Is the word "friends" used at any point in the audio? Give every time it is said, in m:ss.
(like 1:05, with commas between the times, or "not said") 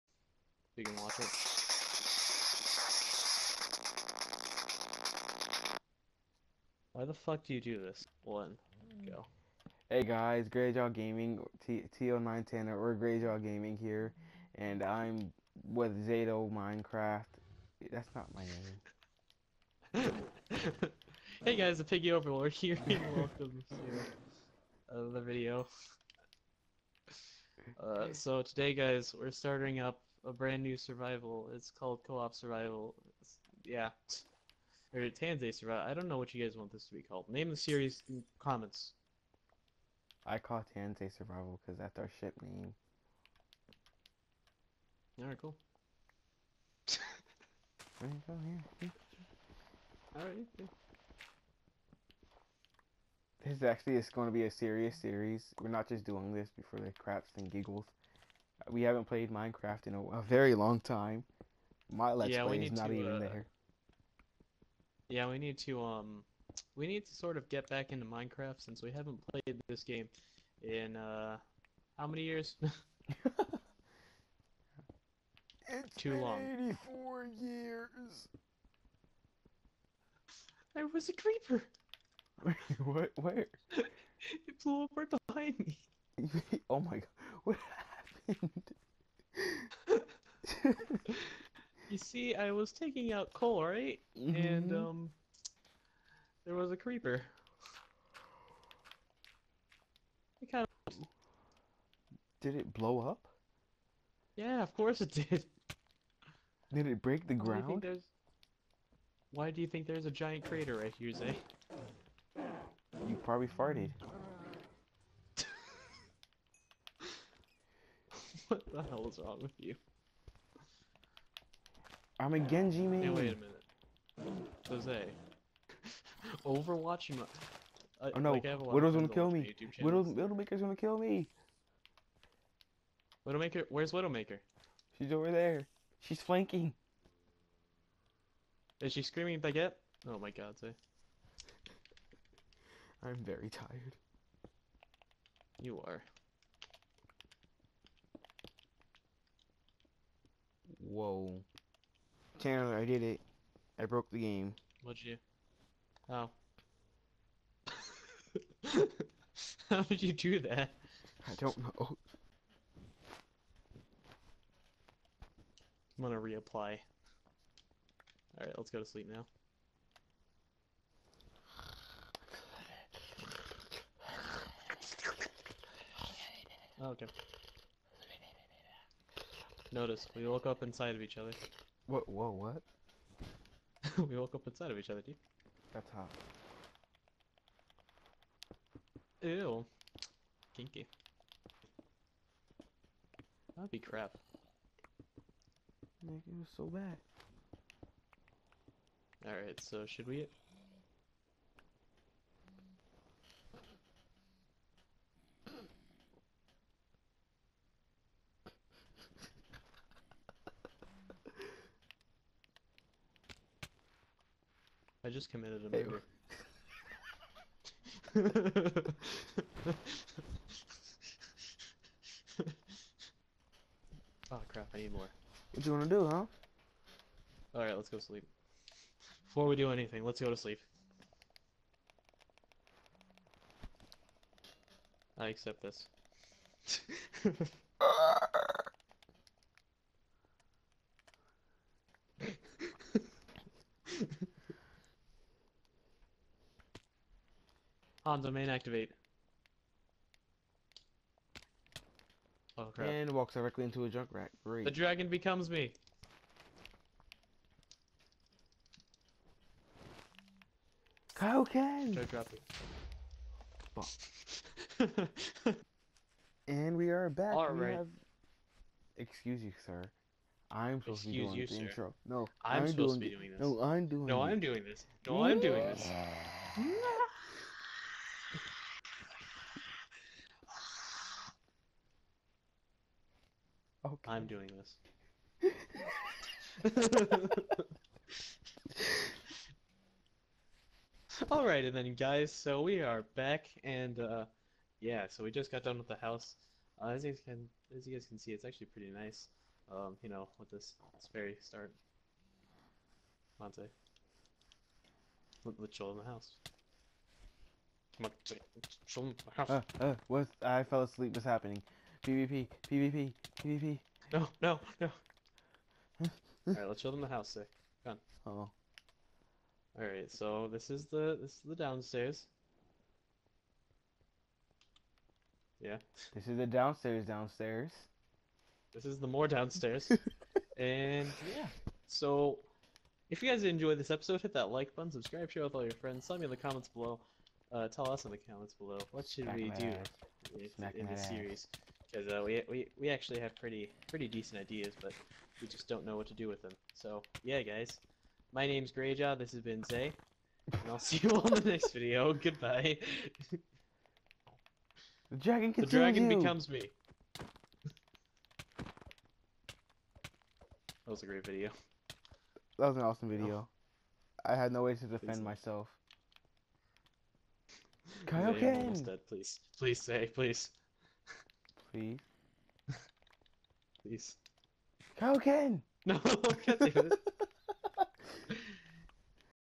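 5:35.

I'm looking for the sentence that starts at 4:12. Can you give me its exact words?
And walks directly into a junk rack.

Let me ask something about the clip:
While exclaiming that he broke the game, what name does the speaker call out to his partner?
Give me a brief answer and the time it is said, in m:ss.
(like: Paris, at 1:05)
Chandler, at 2:32.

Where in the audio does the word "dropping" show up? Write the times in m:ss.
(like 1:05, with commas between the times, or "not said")
4:22.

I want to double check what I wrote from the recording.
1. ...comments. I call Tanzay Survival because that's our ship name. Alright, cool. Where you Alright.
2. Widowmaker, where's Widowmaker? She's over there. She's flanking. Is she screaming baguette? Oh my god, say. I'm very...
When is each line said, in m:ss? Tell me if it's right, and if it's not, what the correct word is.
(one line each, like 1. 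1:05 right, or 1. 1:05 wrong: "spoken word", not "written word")
1. 0:38 right
2. 2:13 right.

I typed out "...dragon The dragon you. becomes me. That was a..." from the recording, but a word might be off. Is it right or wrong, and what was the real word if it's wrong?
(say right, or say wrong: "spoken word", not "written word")
right.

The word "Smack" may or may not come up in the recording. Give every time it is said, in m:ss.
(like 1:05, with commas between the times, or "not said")
5:39.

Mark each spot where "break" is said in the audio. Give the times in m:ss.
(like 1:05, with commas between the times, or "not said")
1:47.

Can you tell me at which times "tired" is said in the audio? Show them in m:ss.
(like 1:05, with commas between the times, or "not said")
2:23.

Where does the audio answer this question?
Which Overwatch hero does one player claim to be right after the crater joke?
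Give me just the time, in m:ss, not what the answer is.
2:02.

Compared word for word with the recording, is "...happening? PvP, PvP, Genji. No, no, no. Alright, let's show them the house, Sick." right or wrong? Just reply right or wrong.
wrong.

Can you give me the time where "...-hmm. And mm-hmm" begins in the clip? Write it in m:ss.
1:34.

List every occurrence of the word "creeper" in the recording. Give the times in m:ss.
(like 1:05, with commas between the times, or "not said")
1:21, 1:36.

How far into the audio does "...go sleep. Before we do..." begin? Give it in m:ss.
3:47.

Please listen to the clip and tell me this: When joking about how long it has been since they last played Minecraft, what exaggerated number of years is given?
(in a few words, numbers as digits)
84.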